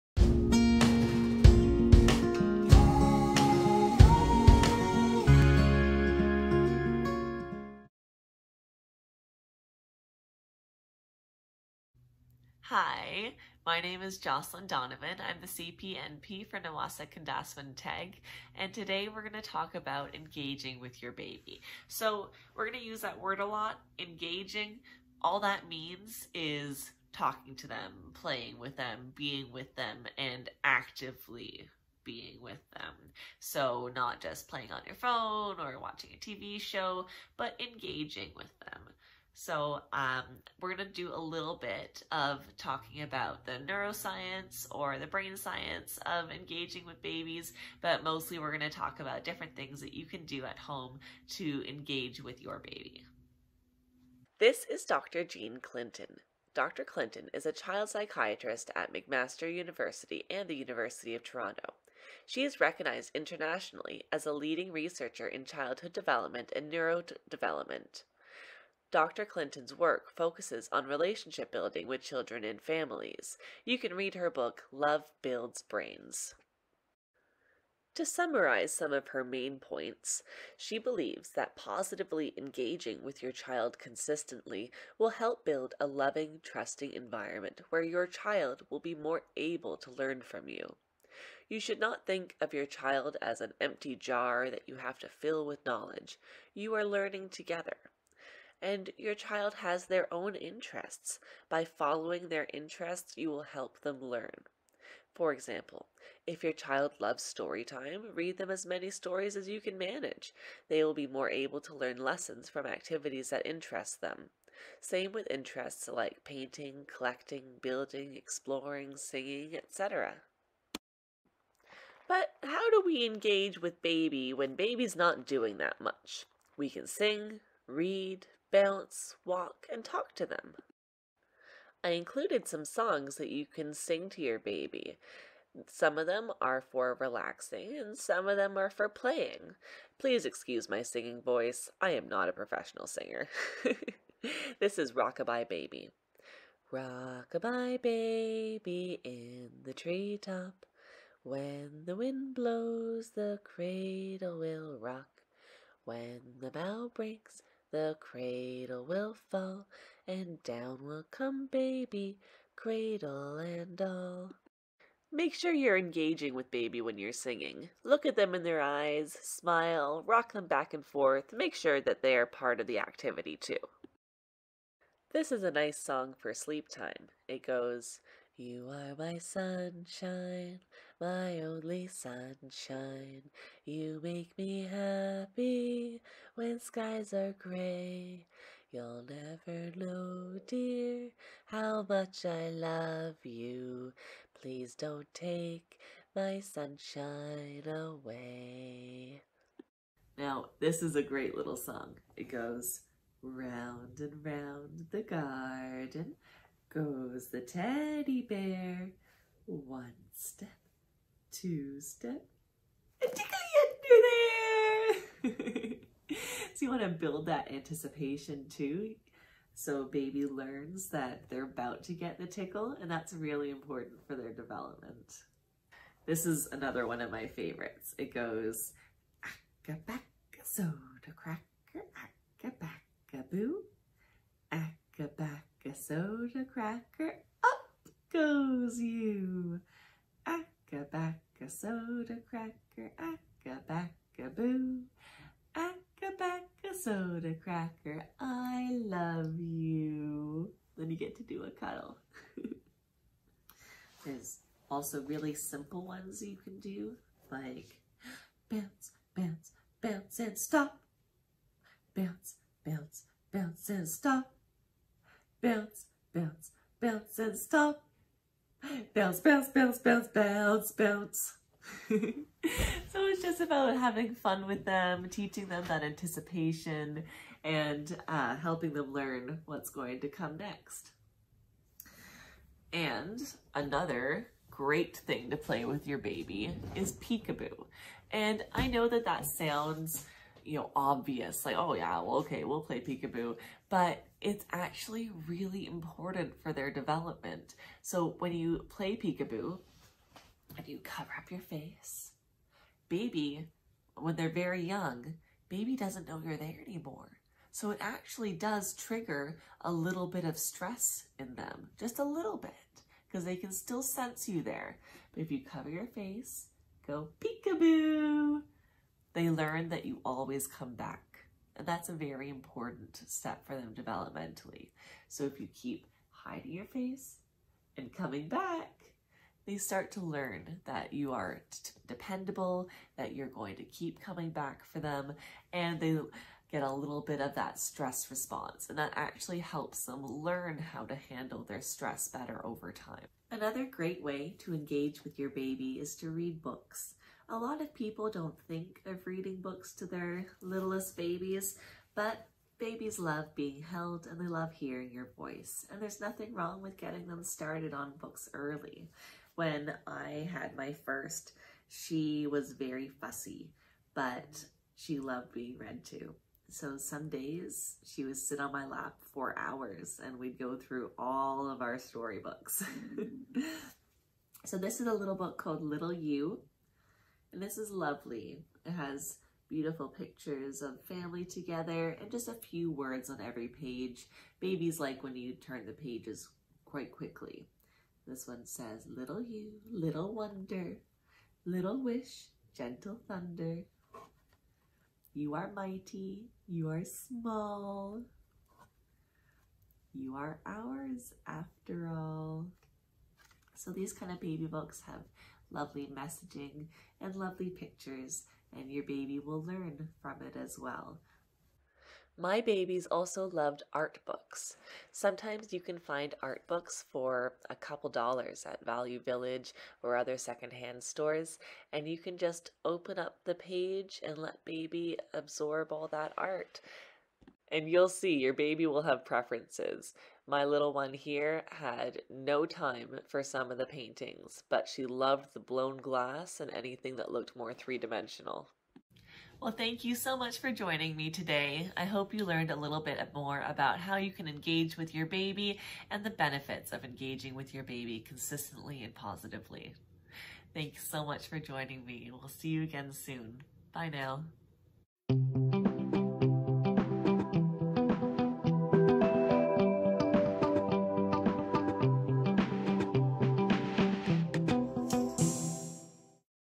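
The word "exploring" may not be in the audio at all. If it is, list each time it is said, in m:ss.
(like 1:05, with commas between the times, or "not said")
1:58.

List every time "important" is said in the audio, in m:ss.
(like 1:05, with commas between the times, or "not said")
3:43, 4:55, 5:22.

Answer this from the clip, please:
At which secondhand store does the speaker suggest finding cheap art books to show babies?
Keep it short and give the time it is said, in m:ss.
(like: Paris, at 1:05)
Value Village, at 6:58.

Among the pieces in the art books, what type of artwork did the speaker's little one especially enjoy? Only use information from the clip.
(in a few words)
blown glass.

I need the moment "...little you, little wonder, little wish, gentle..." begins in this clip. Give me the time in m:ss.
6:28.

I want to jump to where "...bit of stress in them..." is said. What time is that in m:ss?
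5:10.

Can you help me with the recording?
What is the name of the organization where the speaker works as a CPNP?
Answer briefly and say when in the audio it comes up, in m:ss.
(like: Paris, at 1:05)
Niwasa Kendaaswin Teg, at 0:16.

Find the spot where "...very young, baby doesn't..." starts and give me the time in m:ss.
5:04.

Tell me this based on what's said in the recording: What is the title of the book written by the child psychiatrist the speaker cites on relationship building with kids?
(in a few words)
Love Builds Brains.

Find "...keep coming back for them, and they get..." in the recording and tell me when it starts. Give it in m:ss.
5:33.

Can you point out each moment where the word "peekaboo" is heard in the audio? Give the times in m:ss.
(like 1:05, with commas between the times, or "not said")
4:46, 4:52, 4:58, 5:17.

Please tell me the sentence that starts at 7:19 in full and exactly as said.
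Well, thank you so much for joining me today.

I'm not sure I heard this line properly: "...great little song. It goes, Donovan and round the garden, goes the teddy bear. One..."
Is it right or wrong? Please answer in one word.
wrong.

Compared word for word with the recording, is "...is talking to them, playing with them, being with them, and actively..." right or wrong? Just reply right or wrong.
right.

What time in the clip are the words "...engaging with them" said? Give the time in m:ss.
0:37.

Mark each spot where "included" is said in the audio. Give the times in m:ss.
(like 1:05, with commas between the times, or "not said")
2:11.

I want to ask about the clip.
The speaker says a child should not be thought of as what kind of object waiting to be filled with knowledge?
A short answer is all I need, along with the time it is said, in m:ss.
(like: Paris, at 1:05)
an empty jar, at 1:33.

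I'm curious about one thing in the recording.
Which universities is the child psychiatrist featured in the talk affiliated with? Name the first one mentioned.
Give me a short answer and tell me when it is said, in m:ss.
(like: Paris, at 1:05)
McMaster University, at 0:58.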